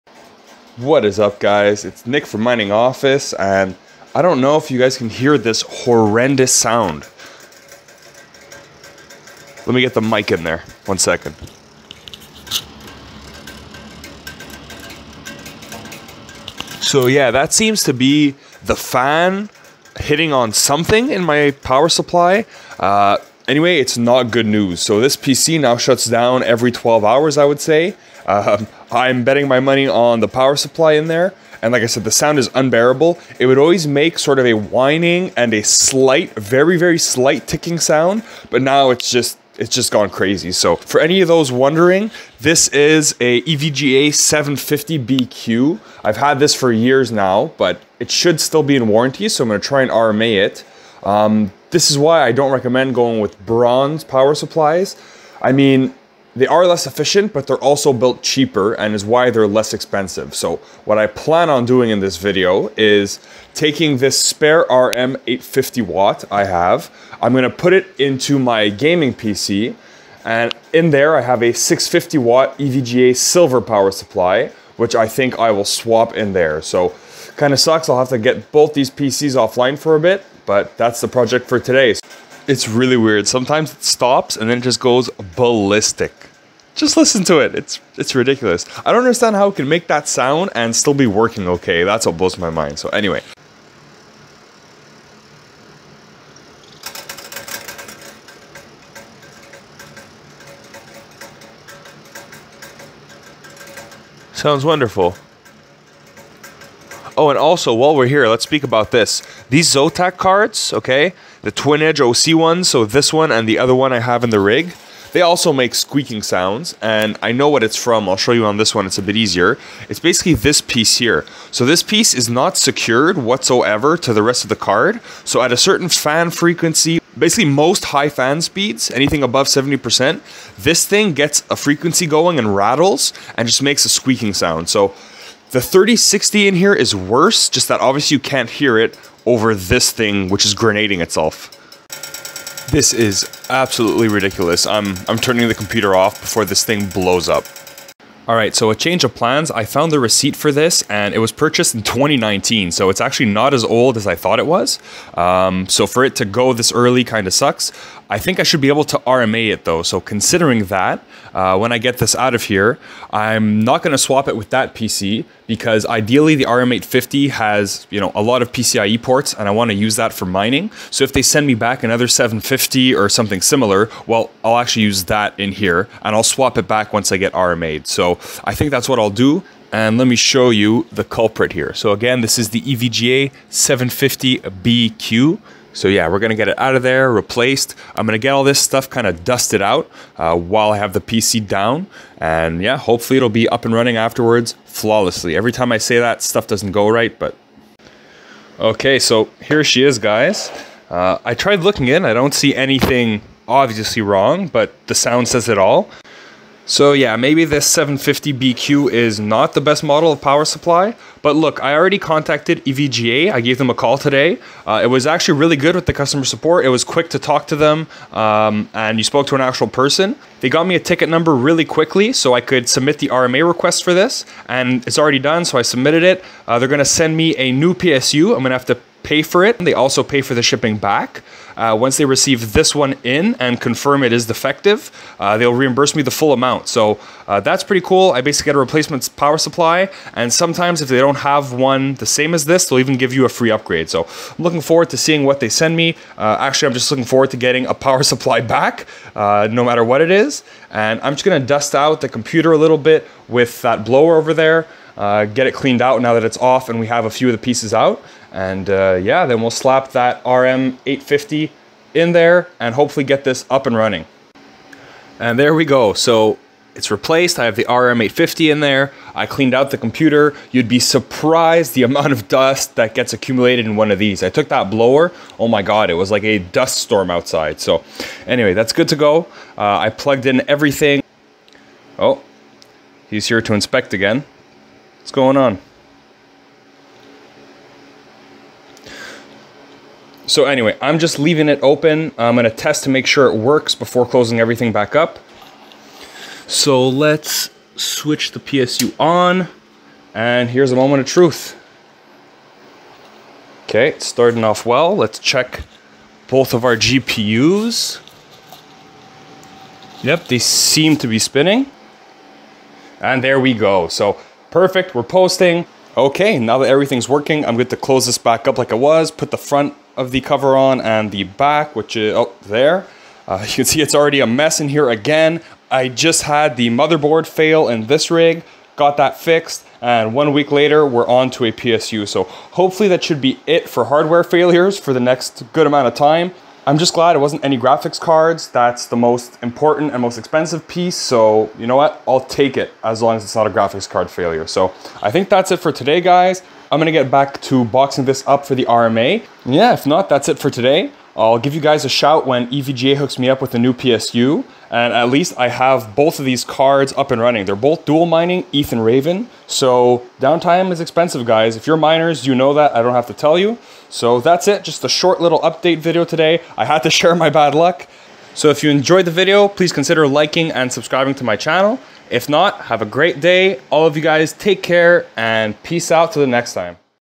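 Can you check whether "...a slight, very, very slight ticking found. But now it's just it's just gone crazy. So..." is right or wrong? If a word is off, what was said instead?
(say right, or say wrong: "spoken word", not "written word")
wrong: "sound", not "found".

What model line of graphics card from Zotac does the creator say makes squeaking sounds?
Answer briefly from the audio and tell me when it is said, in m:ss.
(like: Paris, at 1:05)
Twin Edge OC, at 1:51.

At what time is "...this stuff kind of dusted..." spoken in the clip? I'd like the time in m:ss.
3:08.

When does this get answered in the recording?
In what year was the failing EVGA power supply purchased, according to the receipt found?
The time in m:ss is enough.
2:31.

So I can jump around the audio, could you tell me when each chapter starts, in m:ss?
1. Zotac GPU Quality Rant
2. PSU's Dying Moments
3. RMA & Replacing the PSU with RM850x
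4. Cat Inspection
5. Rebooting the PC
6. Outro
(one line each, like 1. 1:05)
1. 1:47
2. 2:20
3. 2:30
4. 4:40
5. 4:55
6. 5:49.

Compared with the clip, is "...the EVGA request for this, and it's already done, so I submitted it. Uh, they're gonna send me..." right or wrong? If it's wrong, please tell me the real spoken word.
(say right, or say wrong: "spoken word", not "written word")
wrong: "RMA", not "EVGA".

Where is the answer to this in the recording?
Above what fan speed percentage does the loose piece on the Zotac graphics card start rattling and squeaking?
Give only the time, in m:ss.
2:09.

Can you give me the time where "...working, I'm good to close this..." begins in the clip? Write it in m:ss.
5:17.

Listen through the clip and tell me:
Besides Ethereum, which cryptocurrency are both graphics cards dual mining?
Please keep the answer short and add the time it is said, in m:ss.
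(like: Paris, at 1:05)
Raven, at 5:58.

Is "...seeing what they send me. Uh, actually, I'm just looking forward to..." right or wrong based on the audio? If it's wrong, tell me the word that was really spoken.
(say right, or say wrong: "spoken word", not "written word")
right.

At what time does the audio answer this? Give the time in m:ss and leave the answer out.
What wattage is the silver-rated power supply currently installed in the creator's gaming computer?
1:11.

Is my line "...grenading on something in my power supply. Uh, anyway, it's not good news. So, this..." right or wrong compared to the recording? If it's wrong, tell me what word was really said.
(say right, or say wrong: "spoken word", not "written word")
wrong: "hitting", not "grenading".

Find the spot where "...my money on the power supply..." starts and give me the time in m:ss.
0:29.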